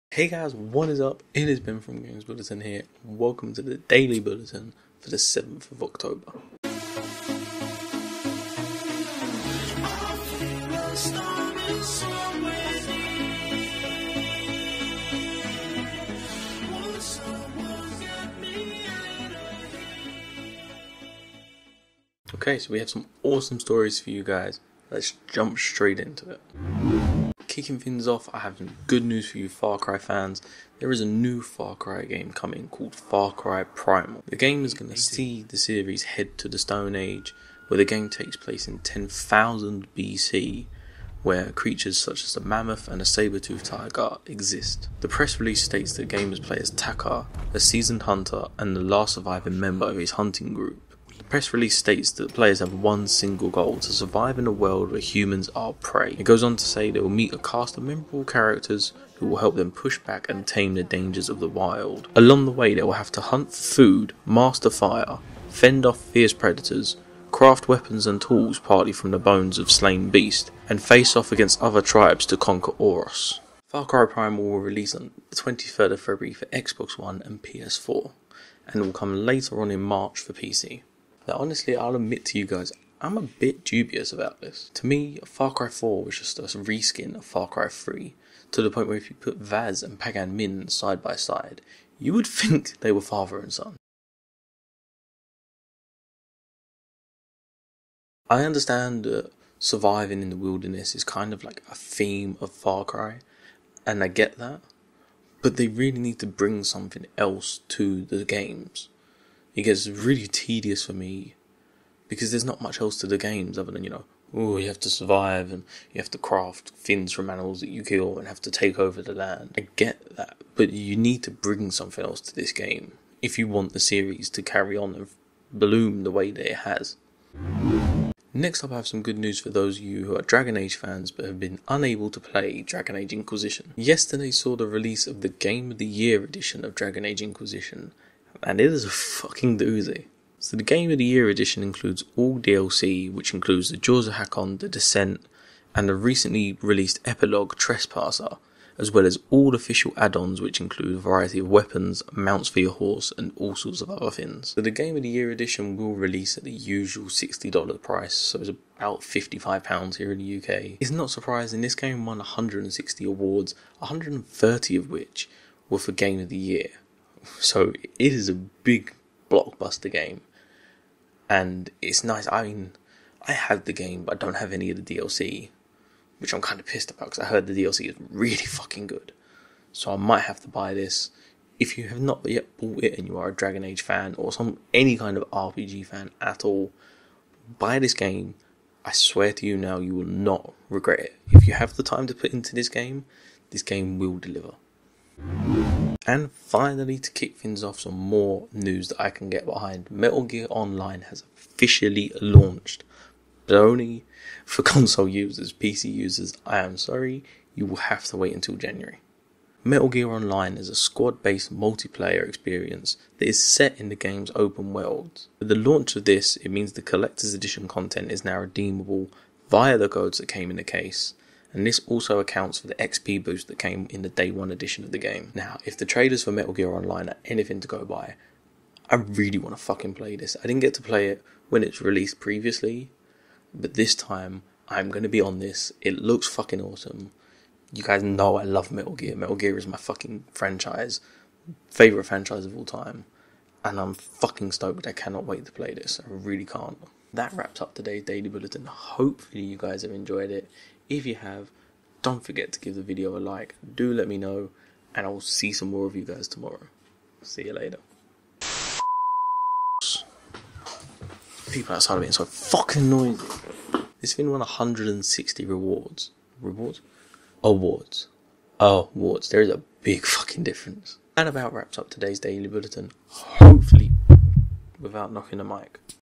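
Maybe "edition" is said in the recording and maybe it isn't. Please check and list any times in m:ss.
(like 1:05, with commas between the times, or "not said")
2:16, 2:21, 2:35, 3:37, 3:44.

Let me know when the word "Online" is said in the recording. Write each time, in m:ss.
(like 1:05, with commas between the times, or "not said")
3:20, 3:30, 3:46.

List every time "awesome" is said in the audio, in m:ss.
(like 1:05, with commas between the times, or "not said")
0:23, 3:56.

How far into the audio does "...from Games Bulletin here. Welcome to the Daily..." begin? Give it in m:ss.
0:01.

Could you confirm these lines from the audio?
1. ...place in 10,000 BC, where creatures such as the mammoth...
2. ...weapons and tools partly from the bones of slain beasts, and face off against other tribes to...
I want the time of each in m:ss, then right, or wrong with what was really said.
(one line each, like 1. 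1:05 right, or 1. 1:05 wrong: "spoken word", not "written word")
1. 0:38 right
2. 1:07 right.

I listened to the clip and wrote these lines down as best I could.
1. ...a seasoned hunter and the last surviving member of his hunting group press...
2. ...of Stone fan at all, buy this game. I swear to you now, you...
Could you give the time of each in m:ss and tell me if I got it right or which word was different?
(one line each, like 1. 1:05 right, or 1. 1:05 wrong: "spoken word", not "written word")
1. 0:47 right
2. 3:05 wrong: "RPG", not "Stone".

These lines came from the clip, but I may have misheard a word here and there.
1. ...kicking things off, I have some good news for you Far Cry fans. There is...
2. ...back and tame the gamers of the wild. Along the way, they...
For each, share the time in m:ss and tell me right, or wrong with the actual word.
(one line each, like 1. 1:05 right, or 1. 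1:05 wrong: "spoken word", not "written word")
1. 0:27 right
2. 0:59 wrong: "dangers", not "gamers".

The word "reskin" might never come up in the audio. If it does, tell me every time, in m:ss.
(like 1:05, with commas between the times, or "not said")
1:26.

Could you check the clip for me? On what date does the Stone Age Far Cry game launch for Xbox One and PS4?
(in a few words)
23rd of February.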